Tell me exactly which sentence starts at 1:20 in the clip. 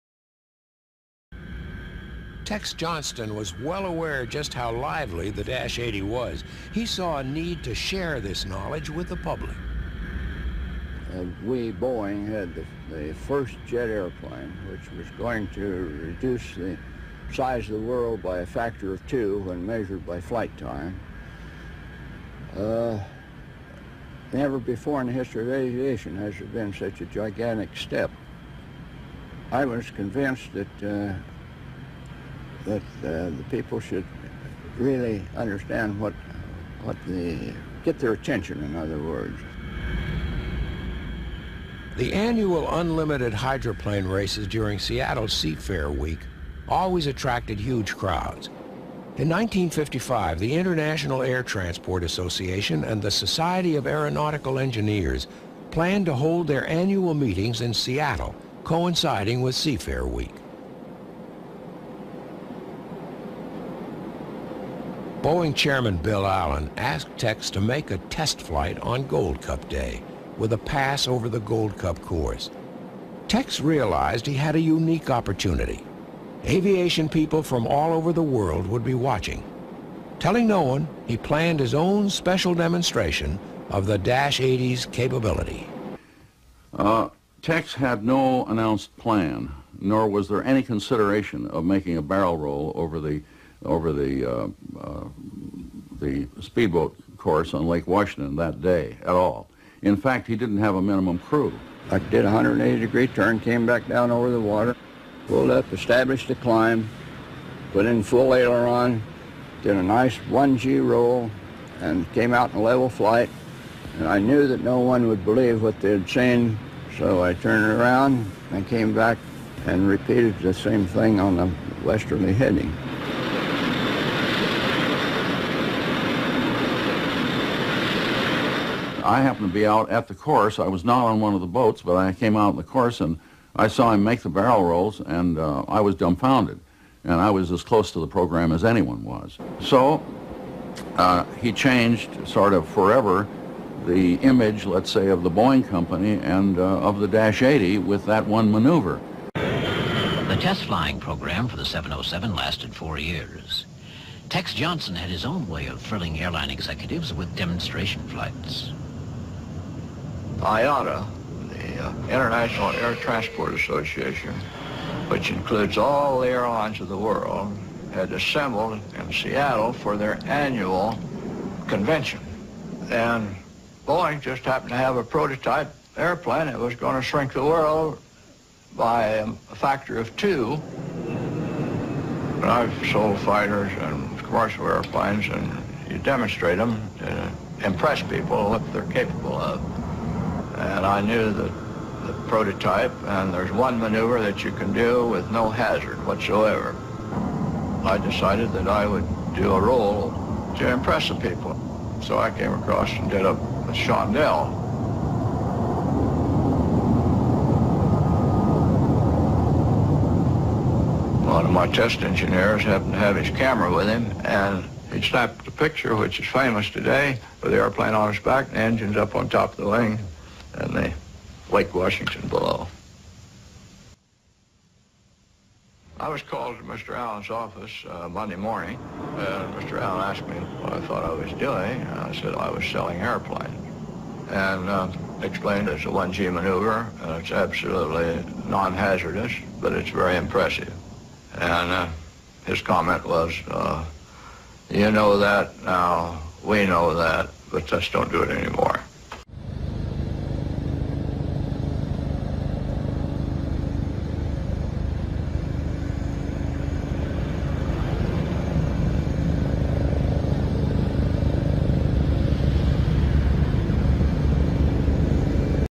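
Telling no one, he planned his own special demonstration of the Dash 80's capability.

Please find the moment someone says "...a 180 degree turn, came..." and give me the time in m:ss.
1:42.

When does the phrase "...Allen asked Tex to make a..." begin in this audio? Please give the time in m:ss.
1:06.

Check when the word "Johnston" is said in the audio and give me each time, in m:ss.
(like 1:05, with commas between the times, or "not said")
0:02, 2:34.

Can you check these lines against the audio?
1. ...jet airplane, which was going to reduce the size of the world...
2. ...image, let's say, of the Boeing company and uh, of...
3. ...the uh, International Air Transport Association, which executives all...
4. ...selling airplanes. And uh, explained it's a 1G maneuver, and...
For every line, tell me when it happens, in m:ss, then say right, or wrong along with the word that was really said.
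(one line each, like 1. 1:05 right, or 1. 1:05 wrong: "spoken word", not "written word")
1. 0:13 right
2. 2:24 right
3. 2:41 wrong: "includes", not "executives"
4. 3:52 right.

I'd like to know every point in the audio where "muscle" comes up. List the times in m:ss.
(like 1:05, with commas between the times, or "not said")
not said.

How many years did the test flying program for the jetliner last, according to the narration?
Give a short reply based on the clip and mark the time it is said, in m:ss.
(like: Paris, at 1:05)
4, at 2:32.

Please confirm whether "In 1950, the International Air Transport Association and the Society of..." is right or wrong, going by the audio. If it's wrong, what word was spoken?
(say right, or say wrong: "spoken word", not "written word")
wrong: "1955", not "1950".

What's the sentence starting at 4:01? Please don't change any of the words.
And uh, his comment was, uh, you know that now, we know that, but just don't do it anymore.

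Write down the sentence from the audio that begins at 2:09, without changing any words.
I happened to be out at the course.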